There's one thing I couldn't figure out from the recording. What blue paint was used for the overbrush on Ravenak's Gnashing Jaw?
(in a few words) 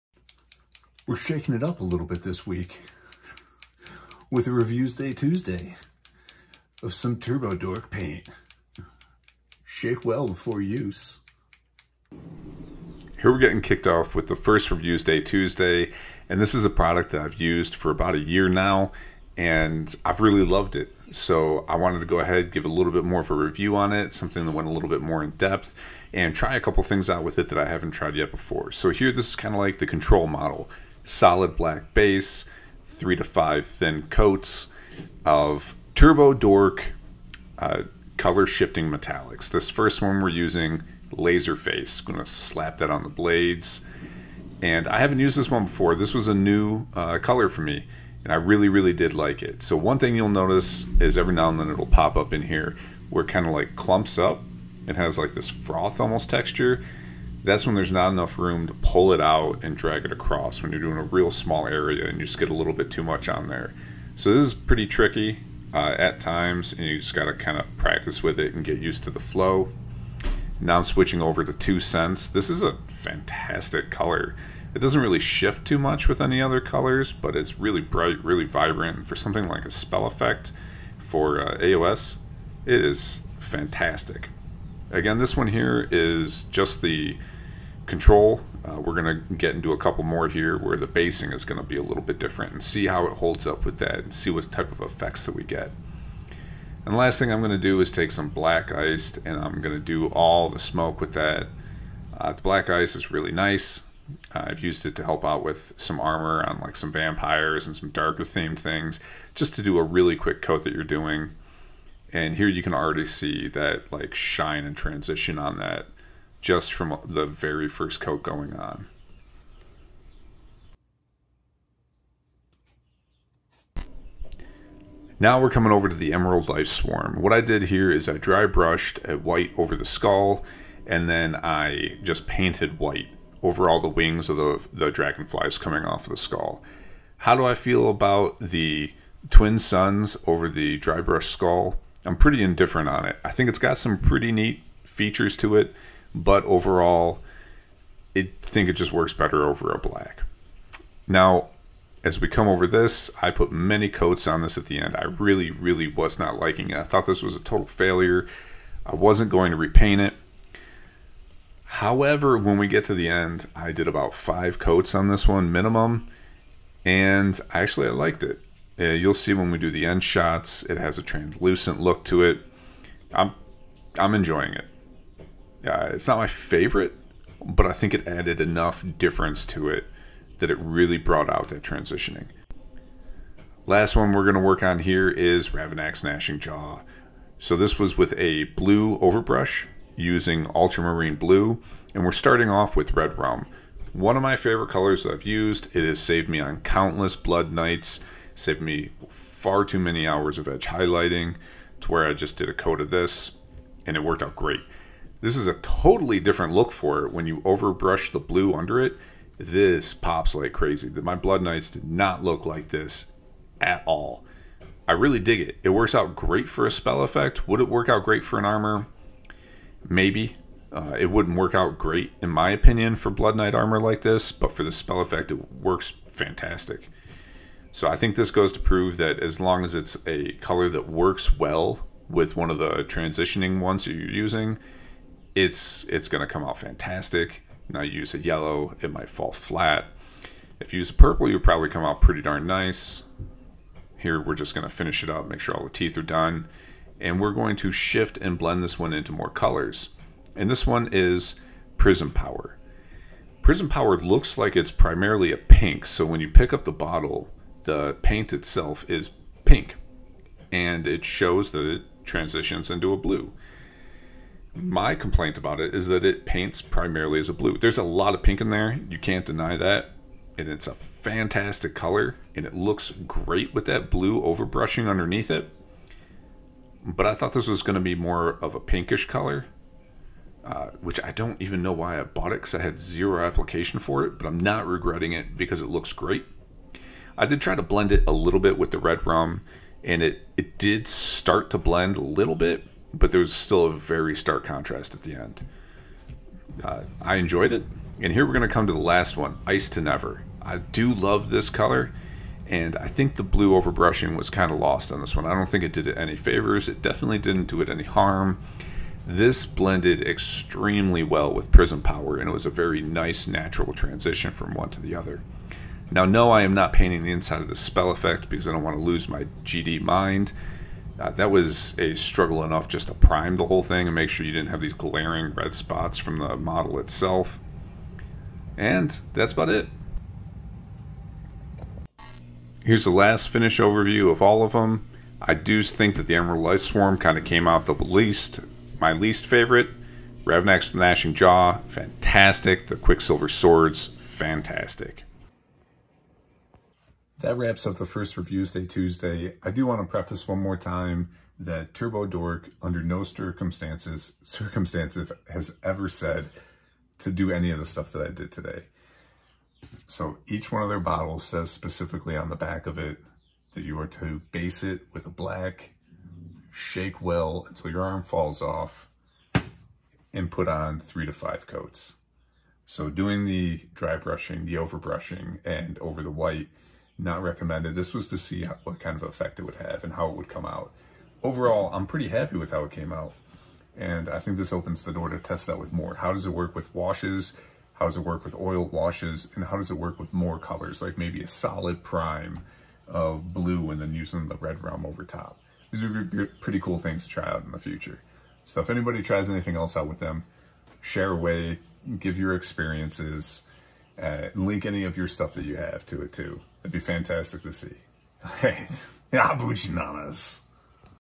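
ultramarine blue.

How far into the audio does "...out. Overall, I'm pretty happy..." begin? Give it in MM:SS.
06:20.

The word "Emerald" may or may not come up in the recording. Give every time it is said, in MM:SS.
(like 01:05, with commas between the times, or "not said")
02:06, 05:36.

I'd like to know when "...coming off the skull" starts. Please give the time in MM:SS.
02:15.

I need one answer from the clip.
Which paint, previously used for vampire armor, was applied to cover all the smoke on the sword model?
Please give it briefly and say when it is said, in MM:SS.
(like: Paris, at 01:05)
Black Ice, at 01:38.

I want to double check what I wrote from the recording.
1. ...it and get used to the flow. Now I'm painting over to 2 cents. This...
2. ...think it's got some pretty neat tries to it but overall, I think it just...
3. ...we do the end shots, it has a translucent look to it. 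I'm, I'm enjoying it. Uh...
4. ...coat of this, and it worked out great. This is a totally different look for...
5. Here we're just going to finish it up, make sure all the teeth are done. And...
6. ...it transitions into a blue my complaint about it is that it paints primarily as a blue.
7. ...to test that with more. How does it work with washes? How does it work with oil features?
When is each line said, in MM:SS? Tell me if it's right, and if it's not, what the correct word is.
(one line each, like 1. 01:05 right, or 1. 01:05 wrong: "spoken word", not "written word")
1. 01:08 wrong: "switching", not "painting"
2. 02:23 wrong: "features", not "tries"
3. 02:49 right
4. 03:22 right
5. 04:03 right
6. 04:21 right
7. 06:25 wrong: "washes", not "features".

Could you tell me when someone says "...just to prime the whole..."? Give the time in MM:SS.
05:22.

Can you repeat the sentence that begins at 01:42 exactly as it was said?
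Uh, the black ice is really nice.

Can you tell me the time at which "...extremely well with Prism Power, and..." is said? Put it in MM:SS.
05:10.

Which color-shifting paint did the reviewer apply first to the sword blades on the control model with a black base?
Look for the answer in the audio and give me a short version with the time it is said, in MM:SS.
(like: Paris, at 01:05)
Laser Face, at 00:41.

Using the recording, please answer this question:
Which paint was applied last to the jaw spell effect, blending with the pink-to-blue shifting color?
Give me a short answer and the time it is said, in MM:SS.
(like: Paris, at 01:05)
Ice to Never, at 04:59.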